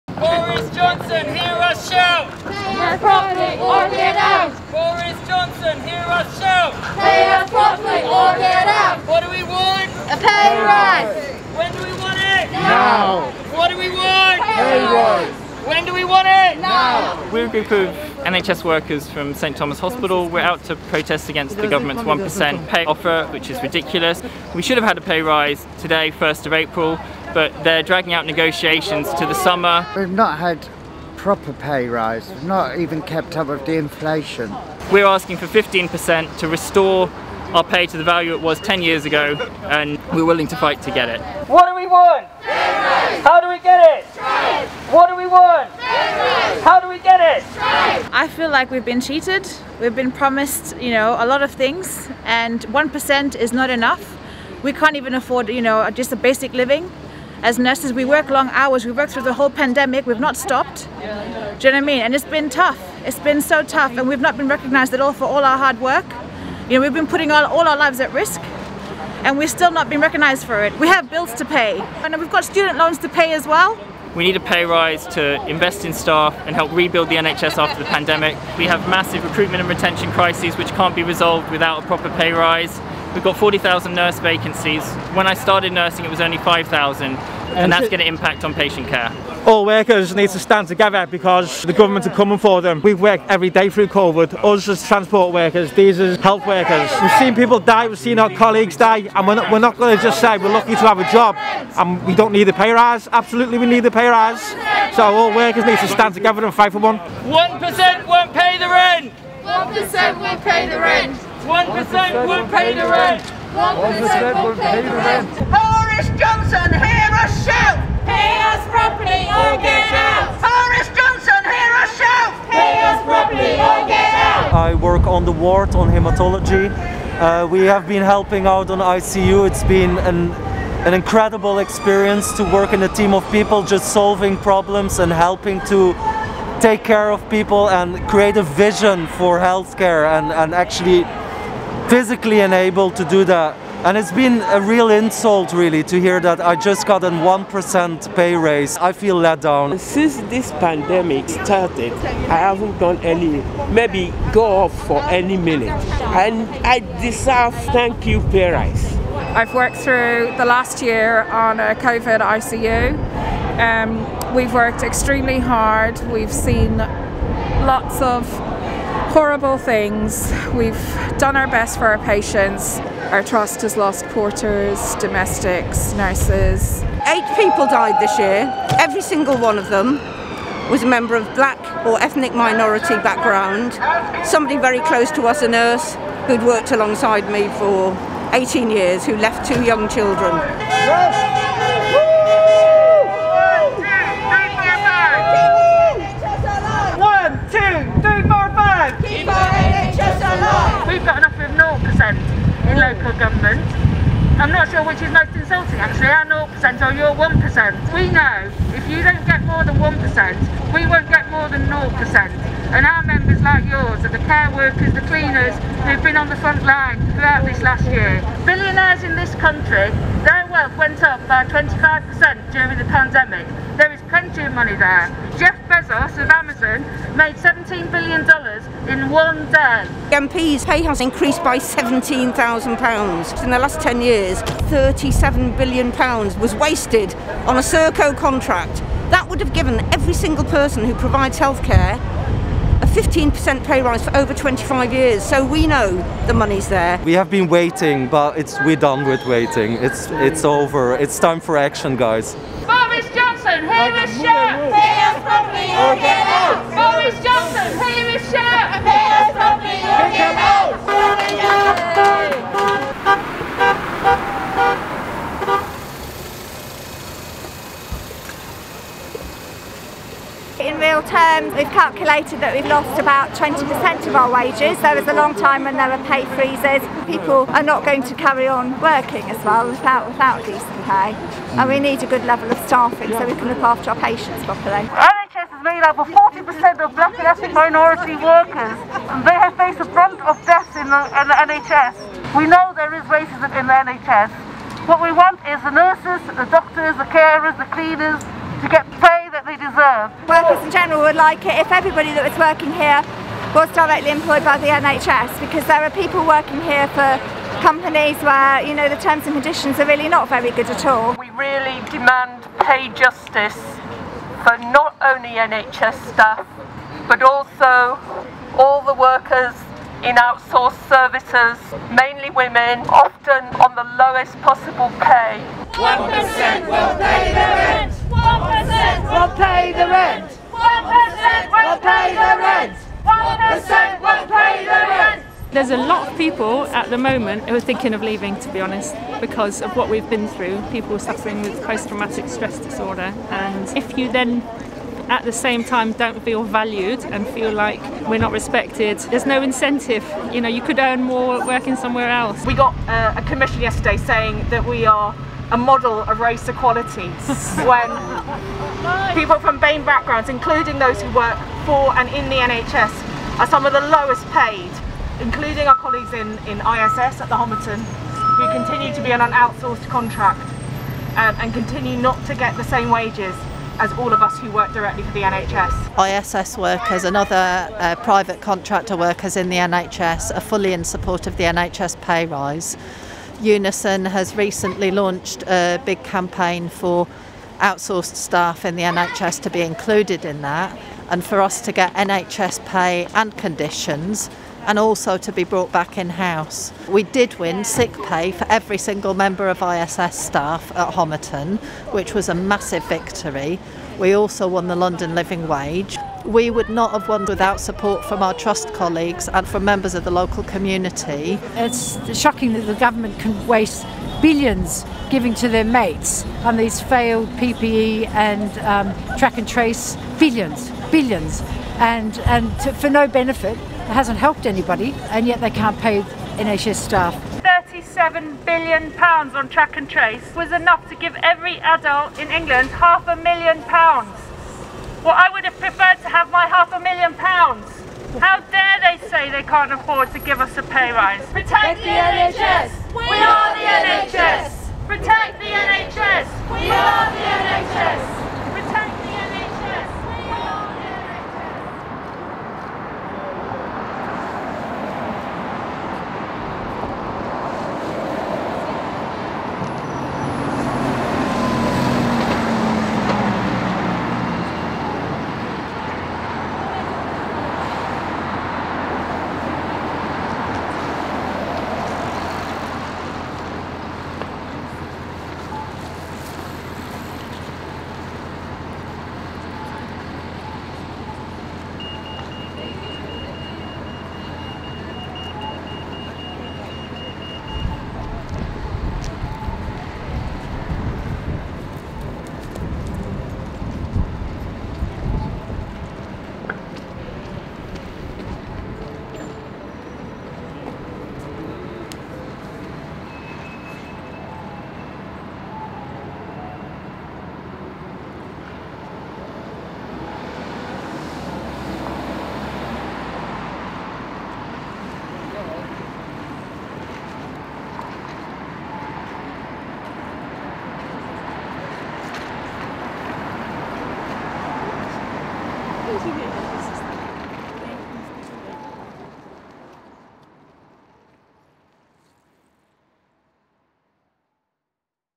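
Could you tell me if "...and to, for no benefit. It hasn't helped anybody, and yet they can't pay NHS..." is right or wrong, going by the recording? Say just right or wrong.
right.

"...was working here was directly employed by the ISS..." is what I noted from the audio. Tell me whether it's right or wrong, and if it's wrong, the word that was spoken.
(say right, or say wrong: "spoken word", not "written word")
wrong: "NHS", not "ISS".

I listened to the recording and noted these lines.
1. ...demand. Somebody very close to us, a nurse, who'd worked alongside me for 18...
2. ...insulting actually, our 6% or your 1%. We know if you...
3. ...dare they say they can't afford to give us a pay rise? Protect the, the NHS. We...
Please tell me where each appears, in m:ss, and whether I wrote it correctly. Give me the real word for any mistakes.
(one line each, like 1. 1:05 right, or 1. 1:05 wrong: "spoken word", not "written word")
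1. 3:02 wrong: "background", not "demand"
2. 3:25 wrong: "0", not "6"
3. 7:18 right.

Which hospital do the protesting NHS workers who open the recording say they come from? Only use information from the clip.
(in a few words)
St Thomas Hospital.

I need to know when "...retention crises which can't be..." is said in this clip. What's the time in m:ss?
1:19.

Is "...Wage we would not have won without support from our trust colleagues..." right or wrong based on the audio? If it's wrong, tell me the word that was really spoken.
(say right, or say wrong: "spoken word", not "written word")
right.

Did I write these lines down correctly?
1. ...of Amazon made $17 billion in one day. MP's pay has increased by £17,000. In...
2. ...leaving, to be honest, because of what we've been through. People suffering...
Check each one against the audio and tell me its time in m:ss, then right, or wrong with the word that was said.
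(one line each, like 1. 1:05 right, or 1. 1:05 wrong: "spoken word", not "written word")
1. 3:46 right
2. 5:38 right.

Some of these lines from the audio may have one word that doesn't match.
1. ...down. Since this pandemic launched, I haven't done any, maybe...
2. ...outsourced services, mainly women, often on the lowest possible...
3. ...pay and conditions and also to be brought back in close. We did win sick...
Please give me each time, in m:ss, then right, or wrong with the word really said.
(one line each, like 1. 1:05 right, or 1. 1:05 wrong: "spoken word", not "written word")
1. 2:29 wrong: "started", not "launched"
2. 5:20 right
3. 6:32 wrong: "house", not "close".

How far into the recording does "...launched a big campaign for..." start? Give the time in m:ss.
6:24.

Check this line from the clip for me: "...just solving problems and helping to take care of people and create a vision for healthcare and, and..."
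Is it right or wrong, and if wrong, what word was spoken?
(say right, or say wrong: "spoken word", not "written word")
right.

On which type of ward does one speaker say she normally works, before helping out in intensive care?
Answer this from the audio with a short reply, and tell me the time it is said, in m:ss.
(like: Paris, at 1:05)
Hematology, at 2:05.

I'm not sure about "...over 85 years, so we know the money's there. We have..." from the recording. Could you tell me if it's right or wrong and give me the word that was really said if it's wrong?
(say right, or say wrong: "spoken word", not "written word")
wrong: "25", not "85".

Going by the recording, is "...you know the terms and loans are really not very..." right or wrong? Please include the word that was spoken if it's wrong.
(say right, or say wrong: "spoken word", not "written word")
wrong: "conditions", not "loans".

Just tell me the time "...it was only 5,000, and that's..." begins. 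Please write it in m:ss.
1:26.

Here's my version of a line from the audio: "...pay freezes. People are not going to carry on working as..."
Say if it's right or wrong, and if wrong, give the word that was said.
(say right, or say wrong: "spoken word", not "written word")
right.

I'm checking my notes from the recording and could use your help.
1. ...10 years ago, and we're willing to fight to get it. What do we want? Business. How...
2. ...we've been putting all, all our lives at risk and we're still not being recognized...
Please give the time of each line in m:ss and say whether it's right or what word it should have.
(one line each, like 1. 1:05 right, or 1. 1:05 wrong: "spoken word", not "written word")
1. 0:38 right
2. 1:06 right.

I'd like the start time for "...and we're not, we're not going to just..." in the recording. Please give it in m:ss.
1:39.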